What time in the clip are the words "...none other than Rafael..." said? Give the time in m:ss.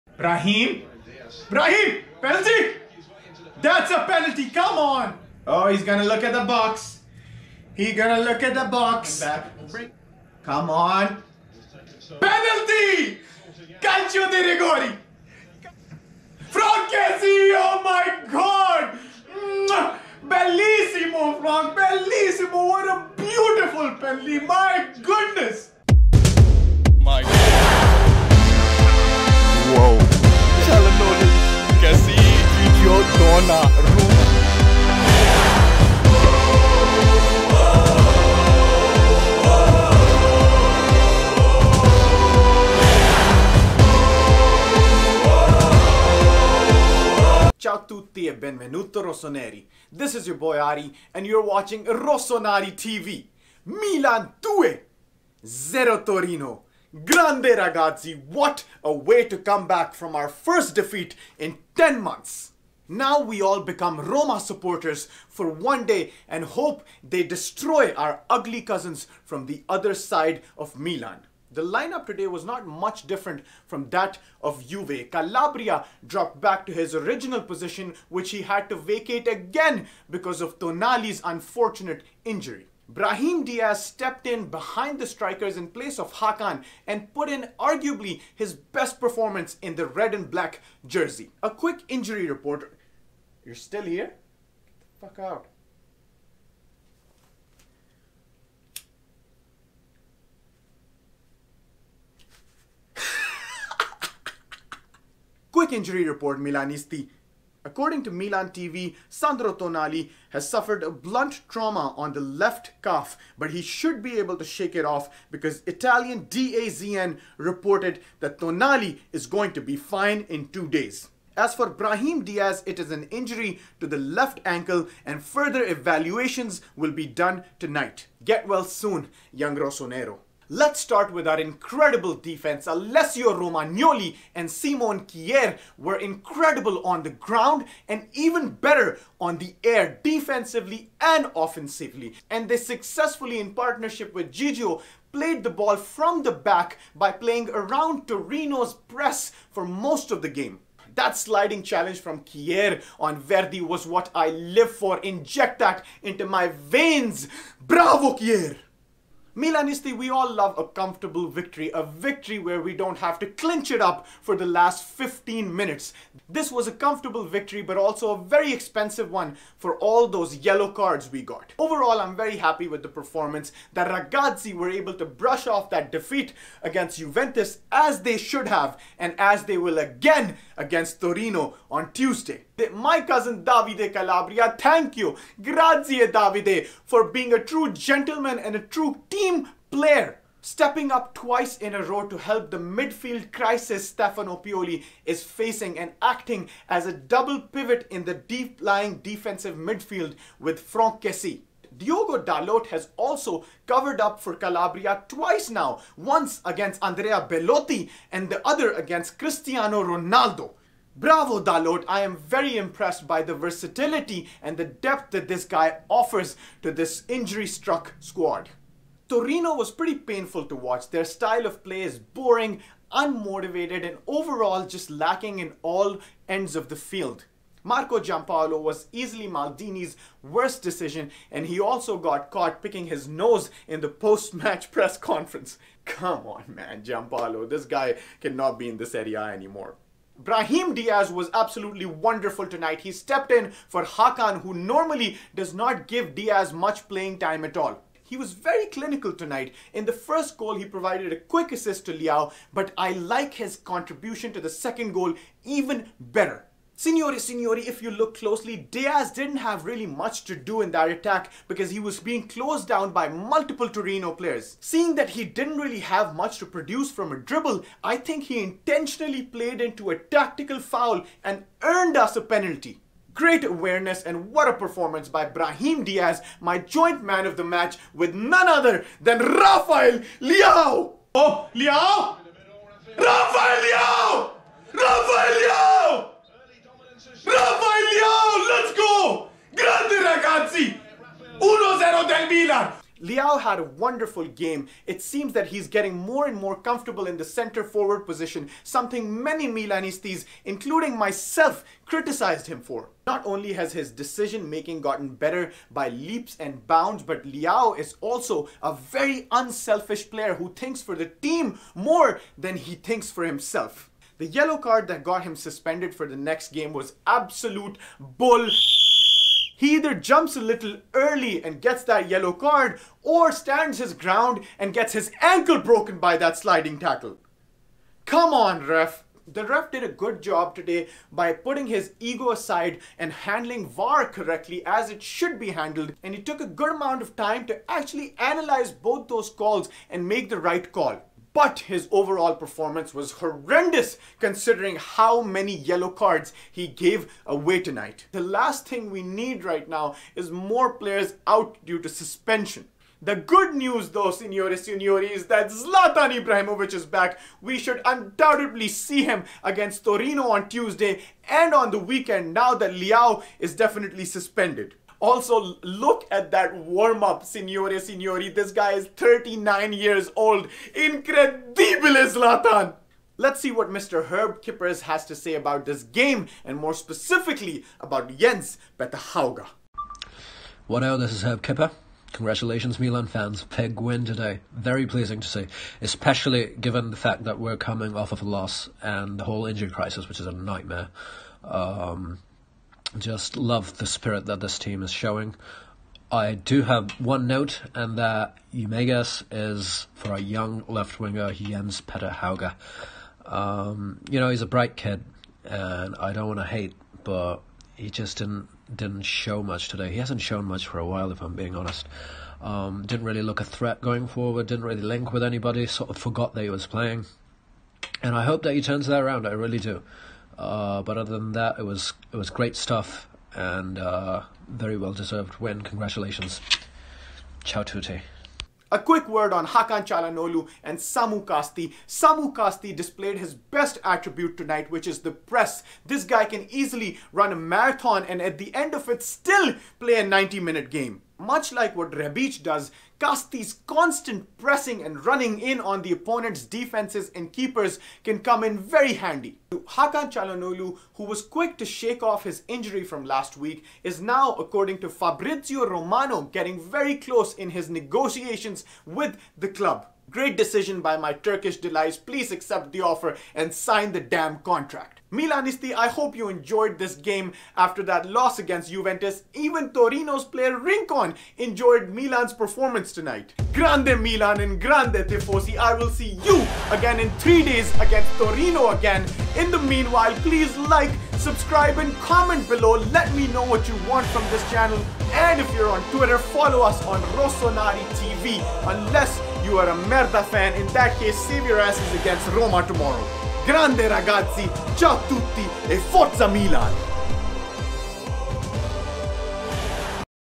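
4:38.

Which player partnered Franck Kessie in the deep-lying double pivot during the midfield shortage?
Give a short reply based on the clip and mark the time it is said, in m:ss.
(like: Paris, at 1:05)
Davide Calabria, at 3:03.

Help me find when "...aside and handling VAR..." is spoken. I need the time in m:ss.
5:32.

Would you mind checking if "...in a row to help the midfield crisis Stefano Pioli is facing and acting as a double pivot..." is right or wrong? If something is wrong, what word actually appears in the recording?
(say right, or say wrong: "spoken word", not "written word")
right.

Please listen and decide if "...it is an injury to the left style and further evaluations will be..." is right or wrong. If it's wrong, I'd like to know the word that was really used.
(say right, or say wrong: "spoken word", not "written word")
wrong: "ankle", not "style".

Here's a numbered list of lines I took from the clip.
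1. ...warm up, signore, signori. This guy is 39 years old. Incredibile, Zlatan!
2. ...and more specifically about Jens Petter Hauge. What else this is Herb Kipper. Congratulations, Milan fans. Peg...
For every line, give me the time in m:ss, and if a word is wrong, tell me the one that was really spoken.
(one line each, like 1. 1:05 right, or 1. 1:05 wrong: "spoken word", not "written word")
1. 6:06 right
2. 6:16 right.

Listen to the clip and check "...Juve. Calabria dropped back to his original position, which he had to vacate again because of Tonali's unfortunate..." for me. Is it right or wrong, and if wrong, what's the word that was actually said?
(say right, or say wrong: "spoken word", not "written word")
right.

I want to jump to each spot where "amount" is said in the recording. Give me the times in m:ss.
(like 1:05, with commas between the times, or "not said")
5:36.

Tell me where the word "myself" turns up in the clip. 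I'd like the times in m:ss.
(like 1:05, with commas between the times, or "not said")
5:00.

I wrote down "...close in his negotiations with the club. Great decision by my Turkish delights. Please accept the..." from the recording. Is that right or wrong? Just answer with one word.
right.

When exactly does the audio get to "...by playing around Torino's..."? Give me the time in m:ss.
2:26.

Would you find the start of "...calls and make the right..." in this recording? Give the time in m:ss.
5:39.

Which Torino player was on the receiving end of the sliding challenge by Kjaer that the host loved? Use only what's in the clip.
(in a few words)
Verdi.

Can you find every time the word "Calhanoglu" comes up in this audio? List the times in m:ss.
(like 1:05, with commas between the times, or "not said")
7:09, 7:30.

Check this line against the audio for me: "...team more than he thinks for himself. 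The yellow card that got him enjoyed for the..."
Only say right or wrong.
wrong.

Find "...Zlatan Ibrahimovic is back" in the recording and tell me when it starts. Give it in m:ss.
5:55.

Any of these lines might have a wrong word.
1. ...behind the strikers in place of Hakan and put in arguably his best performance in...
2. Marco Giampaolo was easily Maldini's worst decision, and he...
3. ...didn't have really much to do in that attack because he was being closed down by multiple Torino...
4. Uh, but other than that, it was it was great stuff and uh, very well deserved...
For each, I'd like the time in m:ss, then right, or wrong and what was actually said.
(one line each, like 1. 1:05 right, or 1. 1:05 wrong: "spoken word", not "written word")
1. 1:24 right
2. 3:47 right
3. 4:19 right
4. 7:00 right.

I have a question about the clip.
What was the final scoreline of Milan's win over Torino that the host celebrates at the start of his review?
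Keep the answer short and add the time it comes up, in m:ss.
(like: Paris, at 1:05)
2-0, at 0:53.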